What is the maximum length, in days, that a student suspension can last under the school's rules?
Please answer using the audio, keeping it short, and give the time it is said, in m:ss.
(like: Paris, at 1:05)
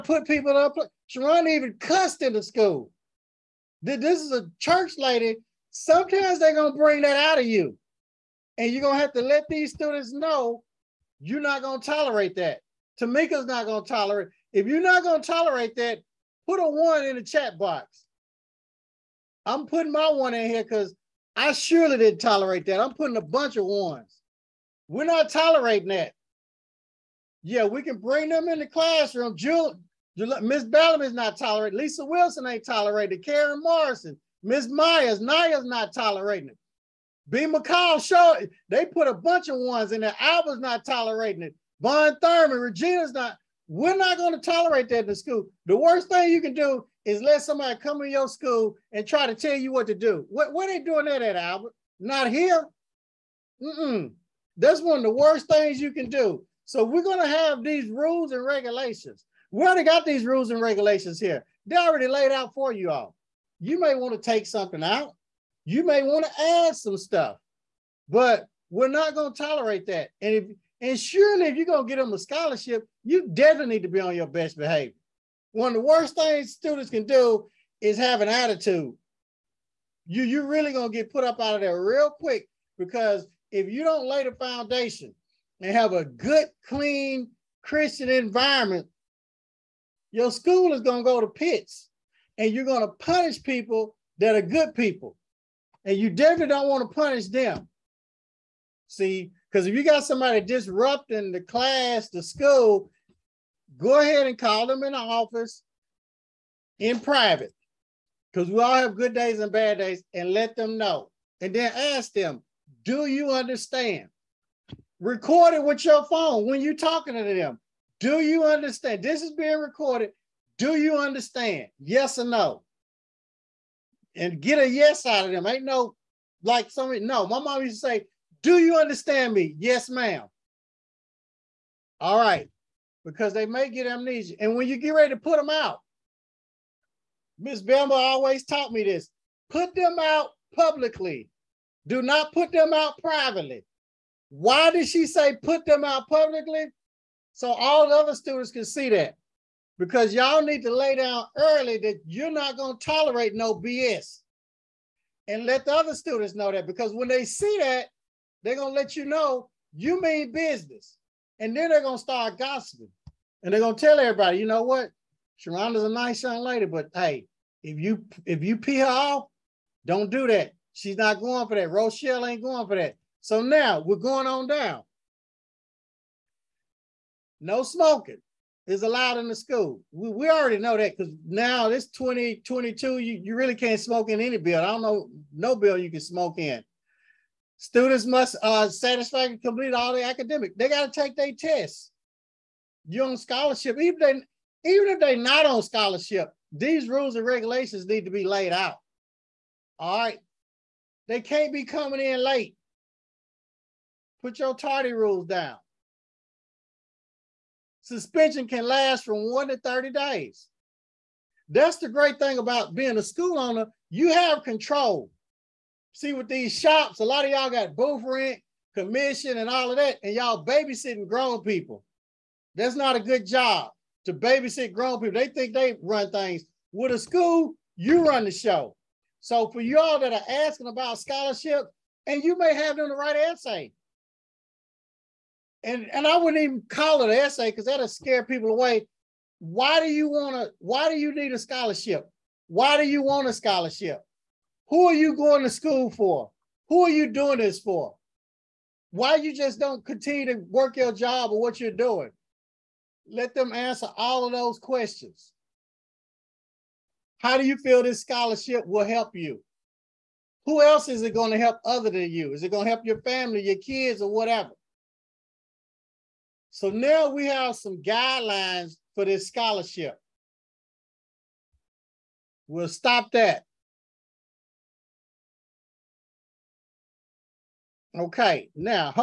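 30 days, at 3:29.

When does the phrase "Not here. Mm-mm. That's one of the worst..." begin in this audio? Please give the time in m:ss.
0:52.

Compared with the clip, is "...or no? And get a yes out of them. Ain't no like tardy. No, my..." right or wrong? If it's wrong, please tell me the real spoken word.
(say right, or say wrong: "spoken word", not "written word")
wrong: "somebody", not "tardy".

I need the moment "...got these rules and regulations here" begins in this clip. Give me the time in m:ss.
0:59.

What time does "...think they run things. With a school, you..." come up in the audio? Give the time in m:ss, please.
3:45.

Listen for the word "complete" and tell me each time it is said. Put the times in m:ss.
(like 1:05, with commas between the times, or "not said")
3:09.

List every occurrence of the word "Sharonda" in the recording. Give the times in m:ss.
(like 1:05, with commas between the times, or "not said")
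0:01, 2:45.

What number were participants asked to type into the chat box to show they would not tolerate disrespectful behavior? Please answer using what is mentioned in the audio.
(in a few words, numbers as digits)
1.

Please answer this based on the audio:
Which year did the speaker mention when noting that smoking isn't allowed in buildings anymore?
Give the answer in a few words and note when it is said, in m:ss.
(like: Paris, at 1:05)
2022, at 3:01.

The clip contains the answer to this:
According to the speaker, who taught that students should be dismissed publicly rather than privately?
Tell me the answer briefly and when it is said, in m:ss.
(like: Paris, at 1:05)
Miss Bamba, at 2:17.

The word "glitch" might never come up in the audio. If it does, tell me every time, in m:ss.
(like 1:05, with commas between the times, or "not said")
not said.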